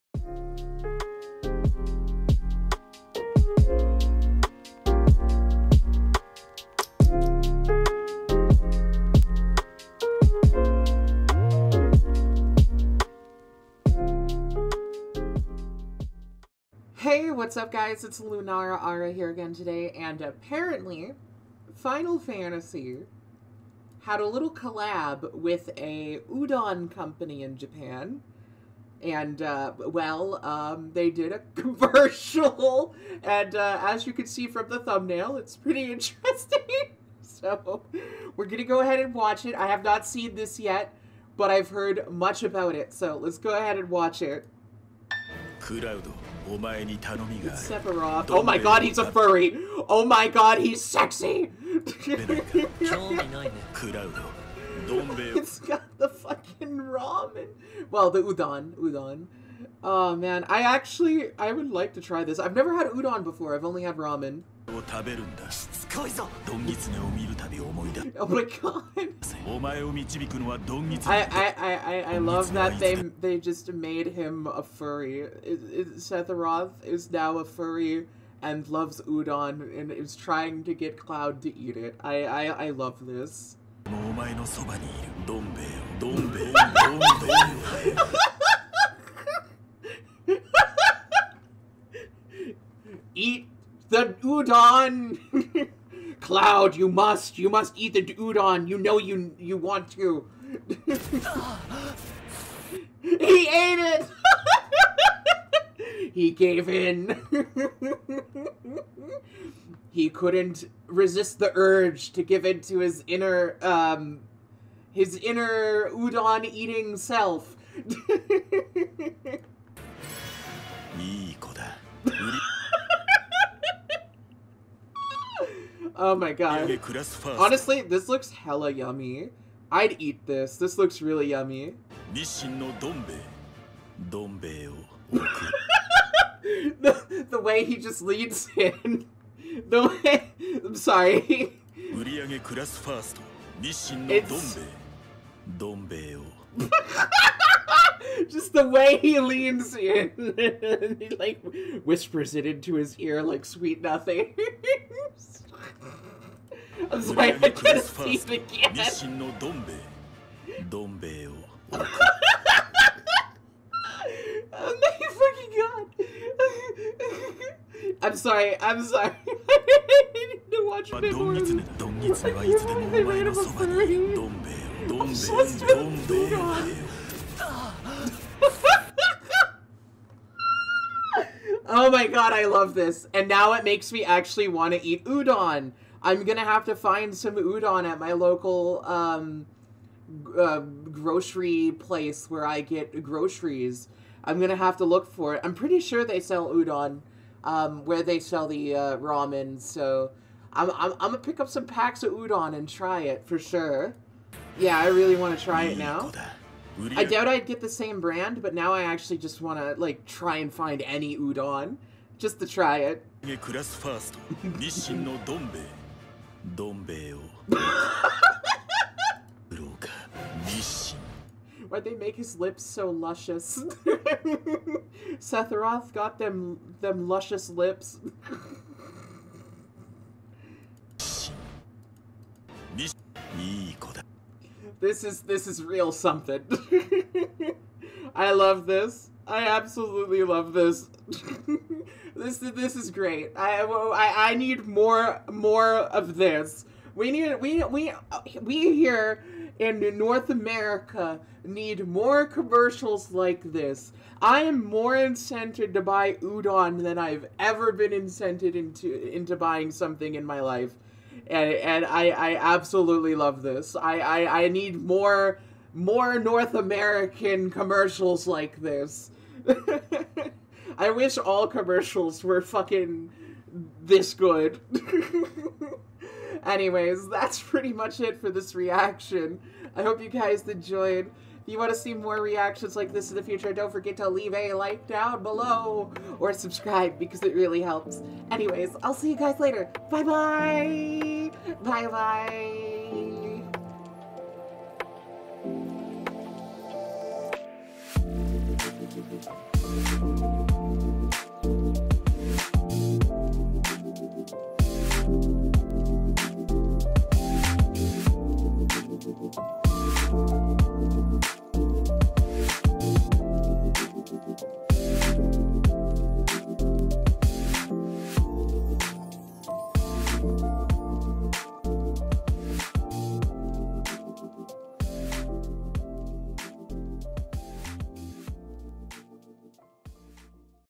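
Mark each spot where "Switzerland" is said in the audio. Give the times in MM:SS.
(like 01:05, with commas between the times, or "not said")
not said.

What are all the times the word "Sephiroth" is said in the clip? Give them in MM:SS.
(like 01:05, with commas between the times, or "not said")
00:47, 01:15.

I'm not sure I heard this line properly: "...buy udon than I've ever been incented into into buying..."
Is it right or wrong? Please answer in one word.
right.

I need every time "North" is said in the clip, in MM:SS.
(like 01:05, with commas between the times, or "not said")
04:09, 04:26.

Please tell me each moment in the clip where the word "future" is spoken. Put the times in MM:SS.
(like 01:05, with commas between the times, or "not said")
04:43.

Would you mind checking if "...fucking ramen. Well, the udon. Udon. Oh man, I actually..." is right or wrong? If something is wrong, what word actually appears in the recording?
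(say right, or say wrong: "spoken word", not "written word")
right.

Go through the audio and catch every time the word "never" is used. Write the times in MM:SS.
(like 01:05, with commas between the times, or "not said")
01:02.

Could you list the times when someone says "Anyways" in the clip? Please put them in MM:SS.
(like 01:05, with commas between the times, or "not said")
04:36, 04:48.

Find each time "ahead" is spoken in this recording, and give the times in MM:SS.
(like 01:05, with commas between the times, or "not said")
00:38, 00:43.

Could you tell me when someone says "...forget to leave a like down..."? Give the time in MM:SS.
04:43.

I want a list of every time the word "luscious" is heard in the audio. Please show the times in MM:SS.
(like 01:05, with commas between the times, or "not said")
03:42, 03:47.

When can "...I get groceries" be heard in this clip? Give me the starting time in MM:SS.
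03:12.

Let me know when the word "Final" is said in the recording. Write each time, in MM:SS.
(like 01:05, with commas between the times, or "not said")
00:21.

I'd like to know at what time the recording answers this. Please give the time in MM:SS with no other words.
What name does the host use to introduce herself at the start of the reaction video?
00:18.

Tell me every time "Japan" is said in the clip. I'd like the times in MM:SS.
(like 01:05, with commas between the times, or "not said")
00:27.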